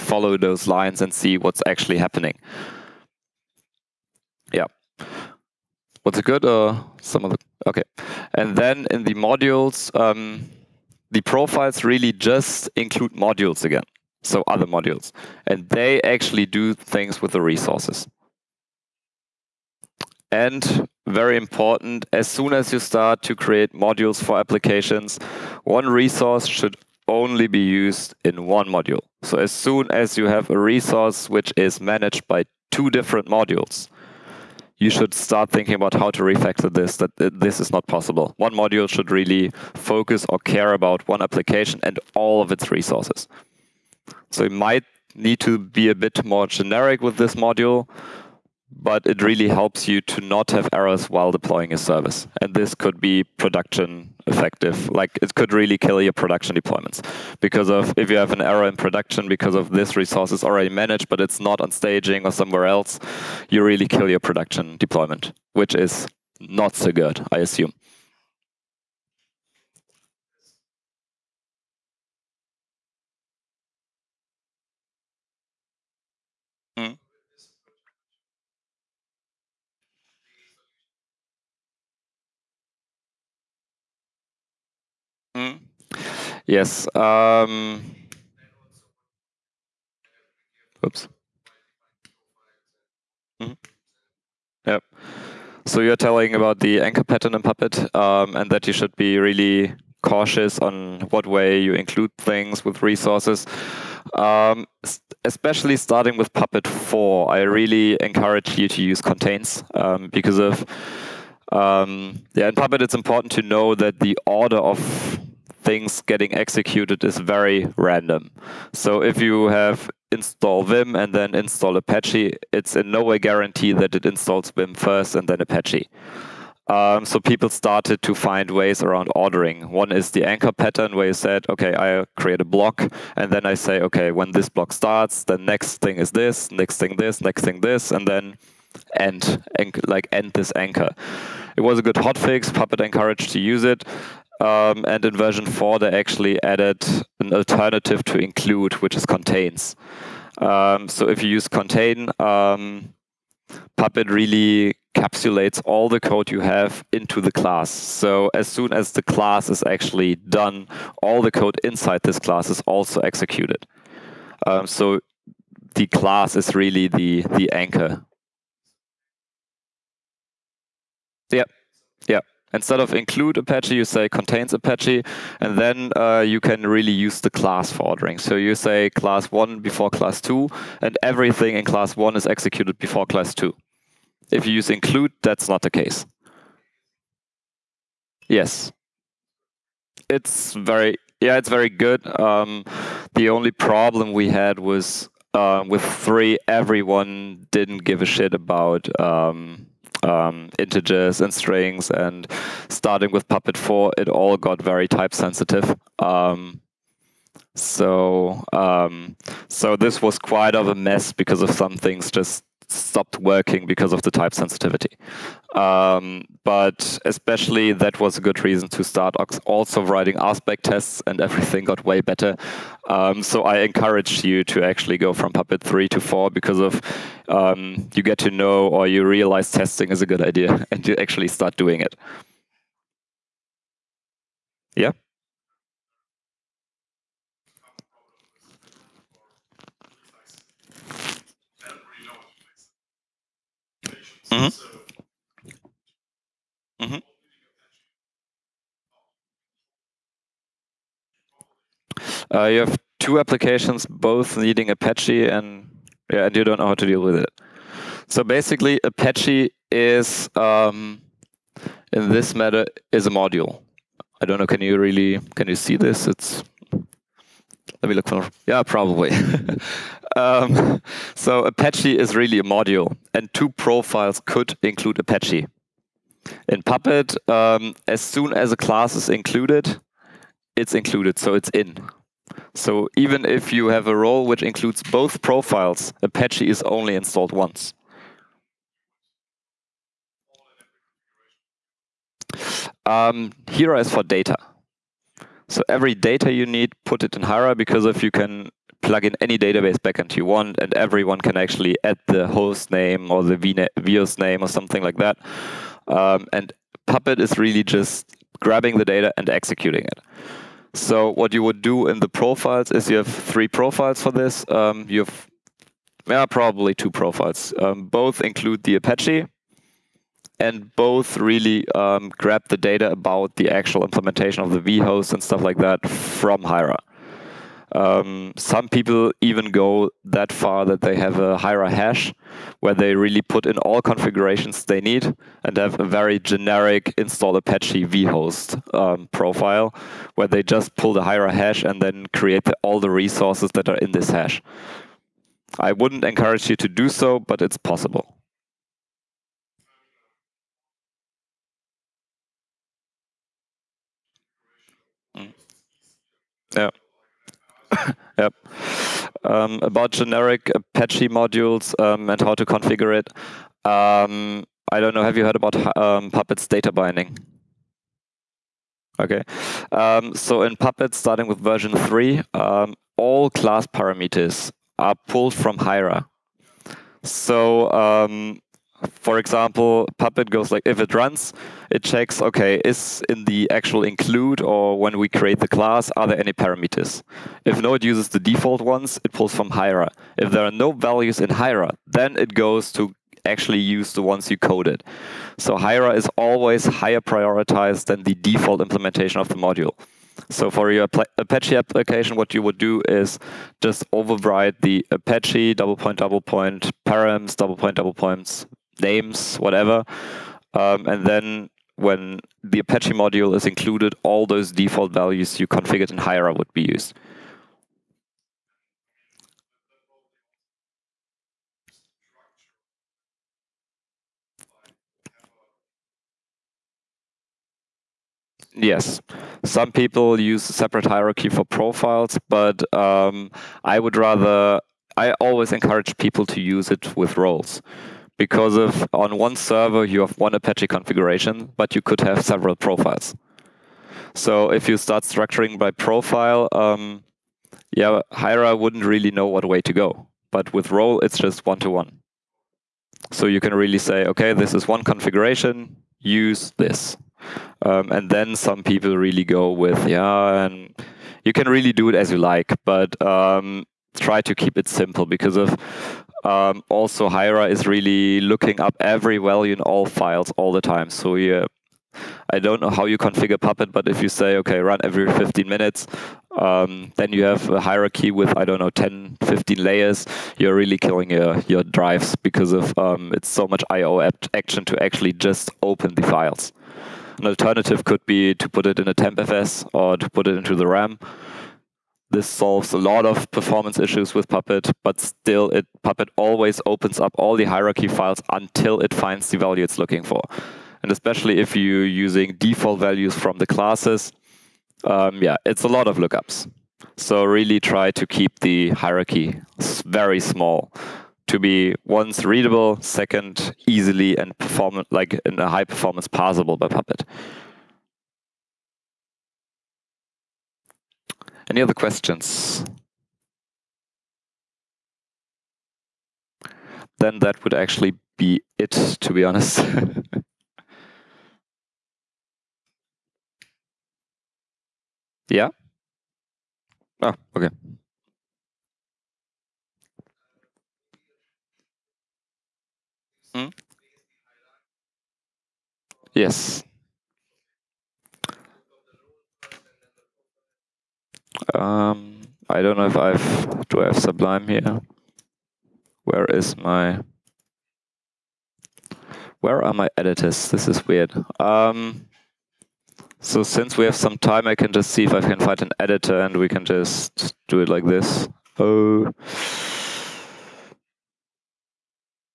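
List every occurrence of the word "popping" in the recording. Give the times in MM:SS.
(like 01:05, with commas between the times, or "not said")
not said.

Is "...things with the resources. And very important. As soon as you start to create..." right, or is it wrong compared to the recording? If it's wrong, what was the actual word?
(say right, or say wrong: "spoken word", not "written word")
right.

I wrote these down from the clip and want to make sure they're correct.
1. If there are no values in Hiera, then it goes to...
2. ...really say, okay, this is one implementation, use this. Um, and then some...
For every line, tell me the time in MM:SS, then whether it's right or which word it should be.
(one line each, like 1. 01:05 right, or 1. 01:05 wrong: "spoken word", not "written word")
1. 06:30 right
2. 07:33 wrong: "configuration", not "implementation".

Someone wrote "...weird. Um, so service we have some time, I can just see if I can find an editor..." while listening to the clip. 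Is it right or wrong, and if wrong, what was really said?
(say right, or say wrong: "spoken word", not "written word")
wrong: "since", not "service".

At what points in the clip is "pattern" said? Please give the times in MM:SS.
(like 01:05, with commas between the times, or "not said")
01:37, 02:10.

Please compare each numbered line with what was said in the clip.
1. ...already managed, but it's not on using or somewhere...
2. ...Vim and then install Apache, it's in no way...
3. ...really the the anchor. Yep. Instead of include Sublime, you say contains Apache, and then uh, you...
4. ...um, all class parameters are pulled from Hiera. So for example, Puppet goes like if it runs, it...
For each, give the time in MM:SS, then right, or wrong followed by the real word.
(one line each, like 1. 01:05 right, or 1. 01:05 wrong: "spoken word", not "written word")
1. 01:00 wrong: "staging", not "using"
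2. 02:00 right
3. 02:46 wrong: "Apache", not "Sublime"
4. 06:12 right.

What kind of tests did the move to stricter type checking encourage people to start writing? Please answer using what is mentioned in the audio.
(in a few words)
rspec tests.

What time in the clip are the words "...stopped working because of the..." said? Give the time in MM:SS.
03:32.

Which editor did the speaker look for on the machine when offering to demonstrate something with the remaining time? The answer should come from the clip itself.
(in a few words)
Sublime.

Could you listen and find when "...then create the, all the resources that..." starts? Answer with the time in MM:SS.
05:41.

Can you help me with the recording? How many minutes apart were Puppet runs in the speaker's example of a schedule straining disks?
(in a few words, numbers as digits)
15.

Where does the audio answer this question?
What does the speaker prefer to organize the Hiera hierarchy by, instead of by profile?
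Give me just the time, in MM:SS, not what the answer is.
07:17.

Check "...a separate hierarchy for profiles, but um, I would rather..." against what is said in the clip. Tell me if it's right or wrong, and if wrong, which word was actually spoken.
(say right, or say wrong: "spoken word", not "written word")
right.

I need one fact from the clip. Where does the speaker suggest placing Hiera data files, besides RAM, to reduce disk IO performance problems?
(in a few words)
tmpfs.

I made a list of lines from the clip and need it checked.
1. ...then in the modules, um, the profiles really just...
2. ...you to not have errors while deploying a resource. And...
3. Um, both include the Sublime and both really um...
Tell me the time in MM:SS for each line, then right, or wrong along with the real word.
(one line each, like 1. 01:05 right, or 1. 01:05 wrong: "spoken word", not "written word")
1. 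00:08 right
2. 00:49 wrong: "service", not "resource"
3. 05:17 wrong: "Apache", not "Sublime".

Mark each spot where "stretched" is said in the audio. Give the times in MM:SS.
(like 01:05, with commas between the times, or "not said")
not said.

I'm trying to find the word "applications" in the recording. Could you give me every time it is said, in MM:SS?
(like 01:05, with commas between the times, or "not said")
00:24, 00:41, 04:13, 06:41.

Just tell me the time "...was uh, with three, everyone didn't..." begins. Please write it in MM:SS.
03:14.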